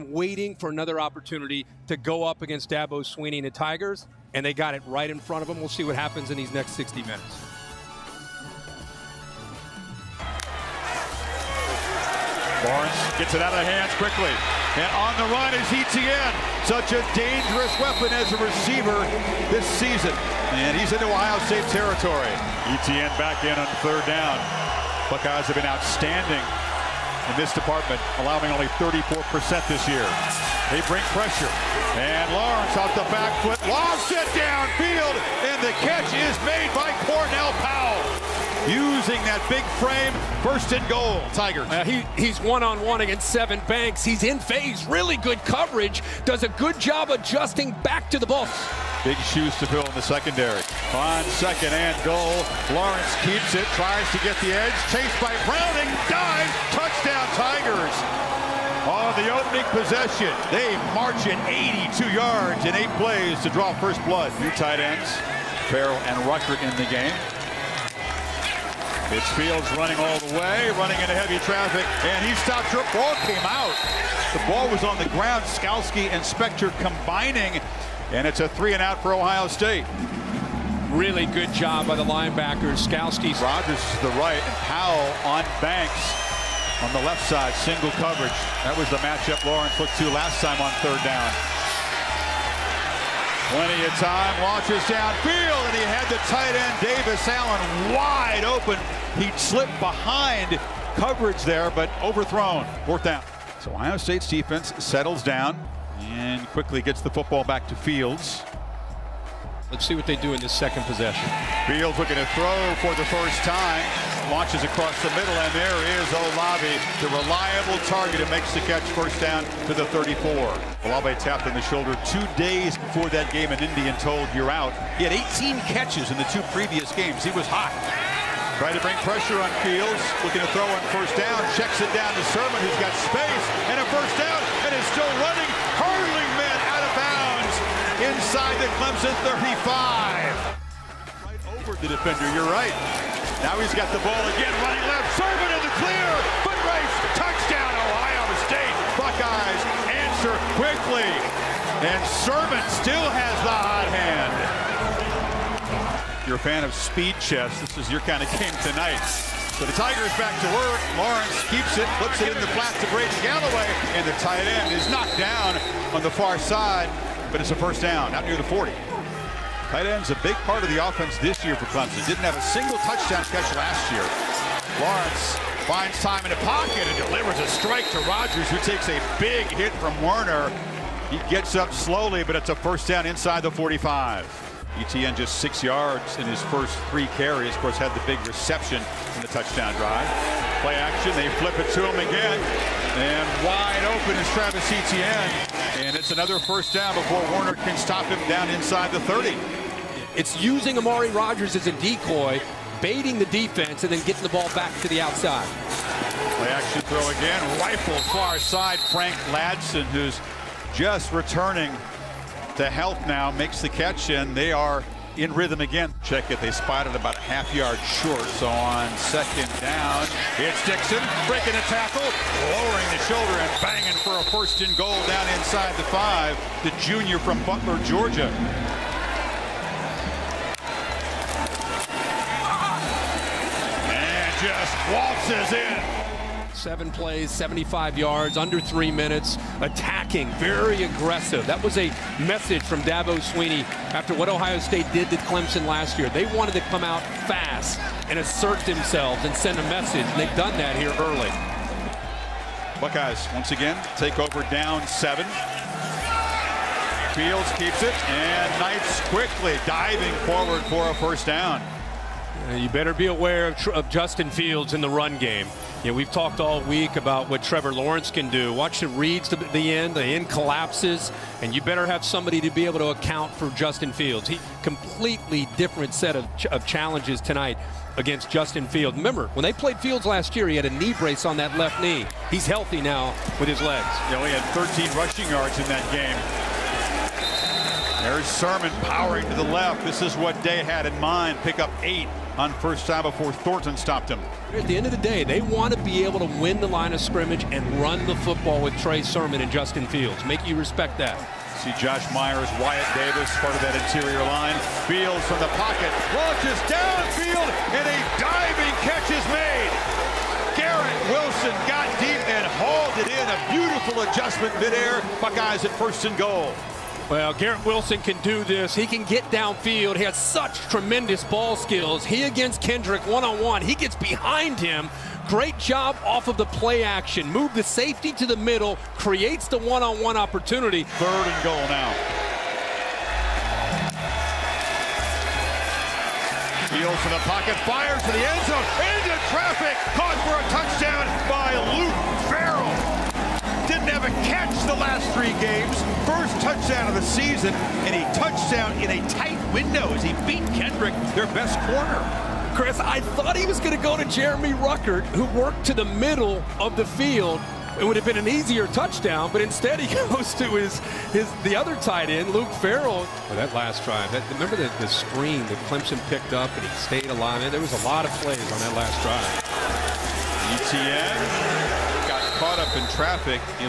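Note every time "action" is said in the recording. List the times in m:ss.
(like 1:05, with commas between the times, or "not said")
3:10, 3:26, 5:26.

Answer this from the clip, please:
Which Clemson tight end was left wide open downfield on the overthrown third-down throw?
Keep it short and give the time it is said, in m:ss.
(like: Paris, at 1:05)
Davis Allen, at 1:36.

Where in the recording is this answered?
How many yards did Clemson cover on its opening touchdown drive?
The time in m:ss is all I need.
1:01.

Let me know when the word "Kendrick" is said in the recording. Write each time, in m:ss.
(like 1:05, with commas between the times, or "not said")
5:22, 5:50.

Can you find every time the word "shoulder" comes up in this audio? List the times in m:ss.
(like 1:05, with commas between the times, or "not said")
2:01, 3:43.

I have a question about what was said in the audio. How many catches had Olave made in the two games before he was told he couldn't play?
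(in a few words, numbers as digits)
18.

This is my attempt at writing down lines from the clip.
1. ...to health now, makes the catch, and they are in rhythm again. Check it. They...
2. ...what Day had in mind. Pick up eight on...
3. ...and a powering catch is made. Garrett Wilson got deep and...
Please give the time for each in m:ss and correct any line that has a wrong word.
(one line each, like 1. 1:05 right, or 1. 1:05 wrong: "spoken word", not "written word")
1. 3:32 right
2. 4:50 right
3. 5:07 wrong: "diving", not "powering".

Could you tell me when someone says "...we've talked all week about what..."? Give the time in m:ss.
4:25.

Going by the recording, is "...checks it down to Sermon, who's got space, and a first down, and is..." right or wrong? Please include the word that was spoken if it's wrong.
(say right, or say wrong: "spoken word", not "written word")
right.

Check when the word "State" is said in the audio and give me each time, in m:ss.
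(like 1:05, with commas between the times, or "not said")
0:21, 1:19, 1:43, 2:28, 4:04.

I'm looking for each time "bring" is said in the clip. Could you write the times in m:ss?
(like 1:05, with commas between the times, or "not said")
0:30, 2:08.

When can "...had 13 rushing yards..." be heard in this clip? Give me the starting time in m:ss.
4:44.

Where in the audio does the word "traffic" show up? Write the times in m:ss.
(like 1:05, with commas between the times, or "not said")
1:11, 5:39, 6:12.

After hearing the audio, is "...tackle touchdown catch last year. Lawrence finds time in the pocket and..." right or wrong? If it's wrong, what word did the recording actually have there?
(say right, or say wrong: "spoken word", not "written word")
wrong: "single", not "tackle".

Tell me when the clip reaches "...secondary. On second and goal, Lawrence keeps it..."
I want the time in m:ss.
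0:50.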